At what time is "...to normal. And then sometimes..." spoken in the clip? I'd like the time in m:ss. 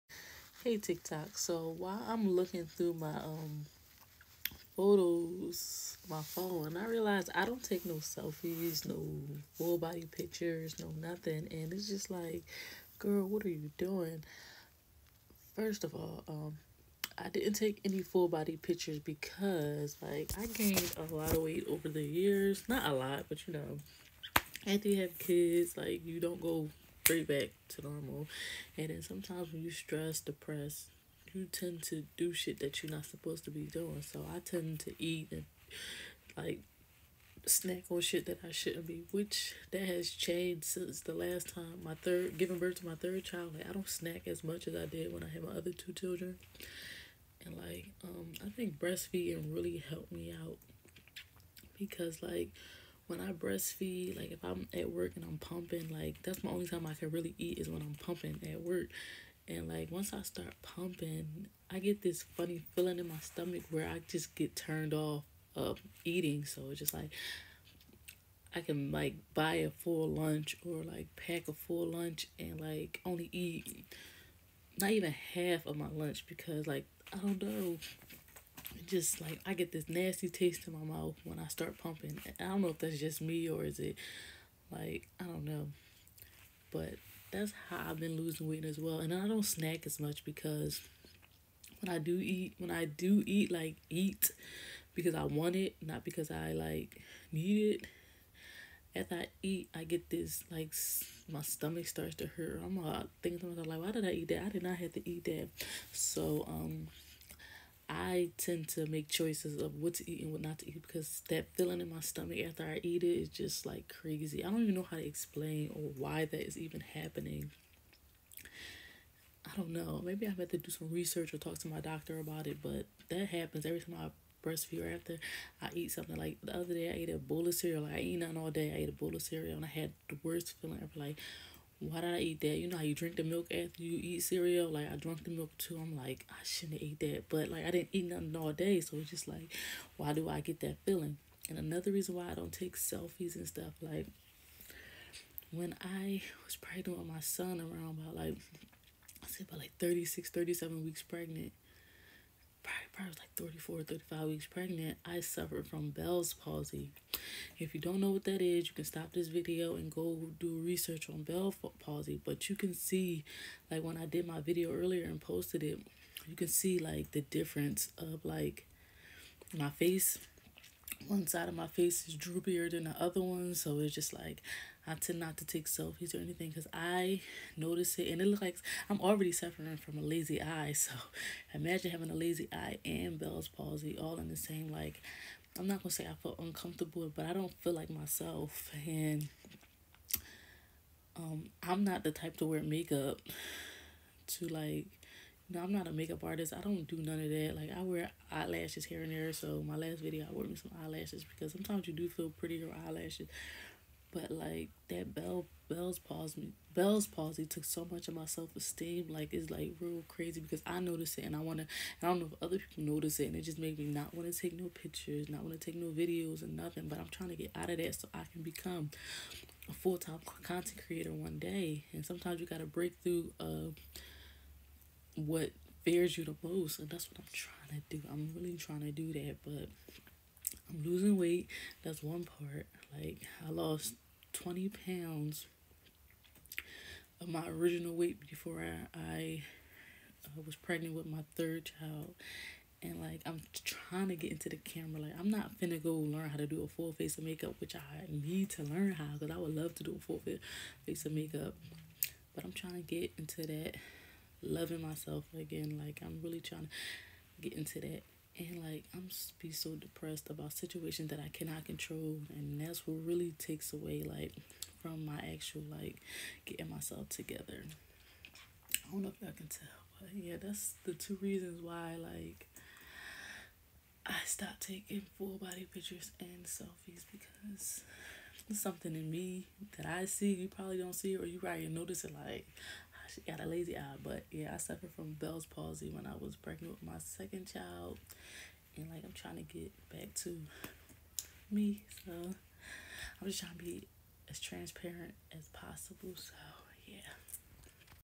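0:27.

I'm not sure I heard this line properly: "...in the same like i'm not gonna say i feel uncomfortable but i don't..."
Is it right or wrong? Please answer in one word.
right.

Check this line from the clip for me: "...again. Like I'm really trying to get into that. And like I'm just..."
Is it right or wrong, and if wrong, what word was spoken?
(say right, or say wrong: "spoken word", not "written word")
right.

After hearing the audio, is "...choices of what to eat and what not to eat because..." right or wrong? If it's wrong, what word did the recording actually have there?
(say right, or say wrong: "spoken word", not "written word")
right.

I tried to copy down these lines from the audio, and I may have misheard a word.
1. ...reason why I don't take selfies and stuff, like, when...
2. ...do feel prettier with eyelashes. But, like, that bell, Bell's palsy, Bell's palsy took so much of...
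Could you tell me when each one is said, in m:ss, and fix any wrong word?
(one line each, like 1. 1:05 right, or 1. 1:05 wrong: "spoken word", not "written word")
1. 2:21 right
2. 3:21 right.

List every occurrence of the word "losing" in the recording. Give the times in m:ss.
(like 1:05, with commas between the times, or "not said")
1:28, 3:50.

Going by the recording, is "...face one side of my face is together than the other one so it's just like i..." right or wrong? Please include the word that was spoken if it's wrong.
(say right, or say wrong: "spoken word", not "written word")
wrong: "droopier", not "together".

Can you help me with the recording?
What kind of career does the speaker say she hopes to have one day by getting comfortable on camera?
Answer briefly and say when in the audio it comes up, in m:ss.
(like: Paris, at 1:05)
full time content creator, at 3:39.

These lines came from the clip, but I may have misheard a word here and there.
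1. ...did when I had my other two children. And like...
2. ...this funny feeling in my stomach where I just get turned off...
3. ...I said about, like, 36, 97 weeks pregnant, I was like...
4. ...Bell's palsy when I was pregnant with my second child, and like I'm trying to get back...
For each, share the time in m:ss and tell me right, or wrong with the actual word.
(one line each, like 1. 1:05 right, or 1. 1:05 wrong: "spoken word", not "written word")
1. 0:44 right
2. 1:02 right
3. 2:29 wrong: "37", not "97"
4. 4:45 right.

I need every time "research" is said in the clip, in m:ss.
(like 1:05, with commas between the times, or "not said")
2:00, 2:40.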